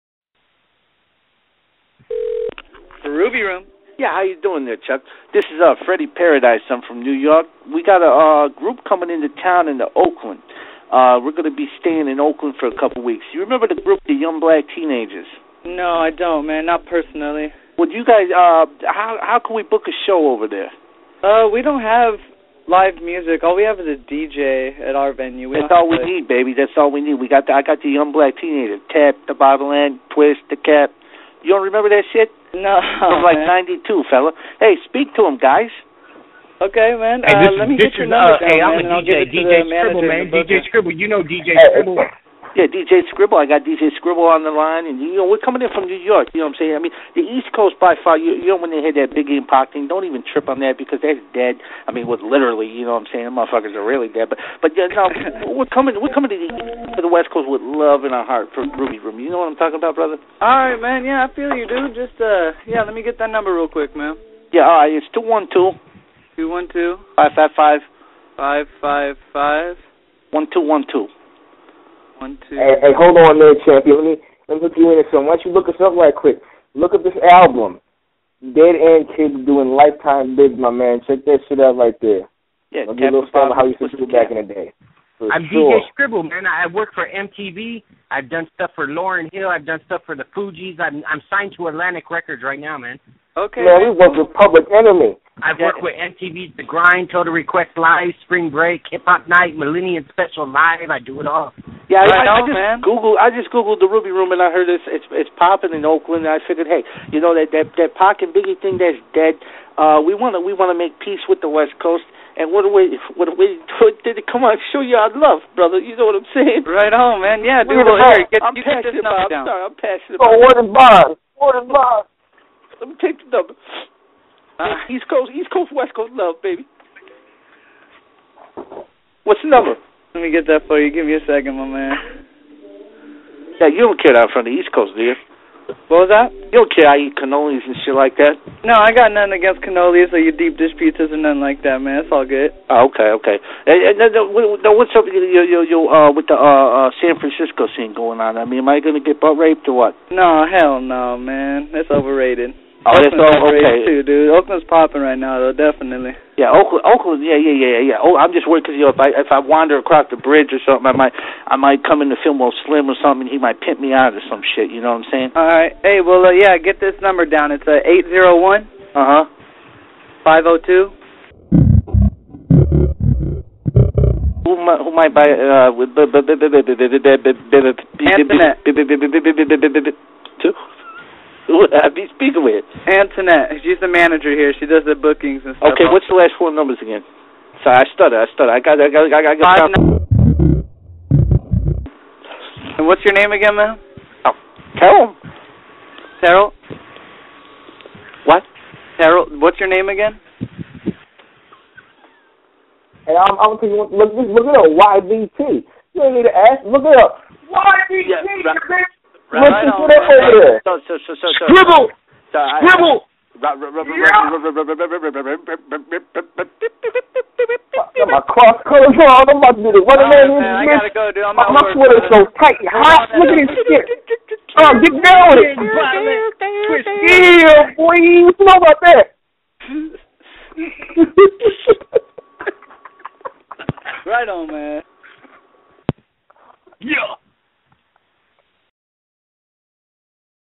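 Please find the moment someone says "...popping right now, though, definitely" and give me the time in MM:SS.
02:34.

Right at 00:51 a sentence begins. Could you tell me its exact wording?
I mean, with literally, you know what I'm saying?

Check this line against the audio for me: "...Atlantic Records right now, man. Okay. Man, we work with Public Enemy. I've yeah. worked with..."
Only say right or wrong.
right.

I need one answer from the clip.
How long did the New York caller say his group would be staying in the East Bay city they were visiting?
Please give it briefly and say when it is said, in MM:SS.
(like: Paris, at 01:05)
a couple weeks, at 00:12.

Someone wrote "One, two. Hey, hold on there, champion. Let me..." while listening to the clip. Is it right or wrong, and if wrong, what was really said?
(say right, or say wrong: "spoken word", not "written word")
right.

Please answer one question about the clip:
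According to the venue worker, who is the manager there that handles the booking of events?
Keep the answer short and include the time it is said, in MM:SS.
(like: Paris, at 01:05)
Antoinette, at 03:02.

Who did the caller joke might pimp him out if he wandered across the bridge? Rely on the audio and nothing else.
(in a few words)
Fillmore Slim.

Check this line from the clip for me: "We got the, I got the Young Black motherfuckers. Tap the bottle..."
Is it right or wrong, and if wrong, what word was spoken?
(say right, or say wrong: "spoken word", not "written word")
wrong: "teenagers", not "motherfuckers".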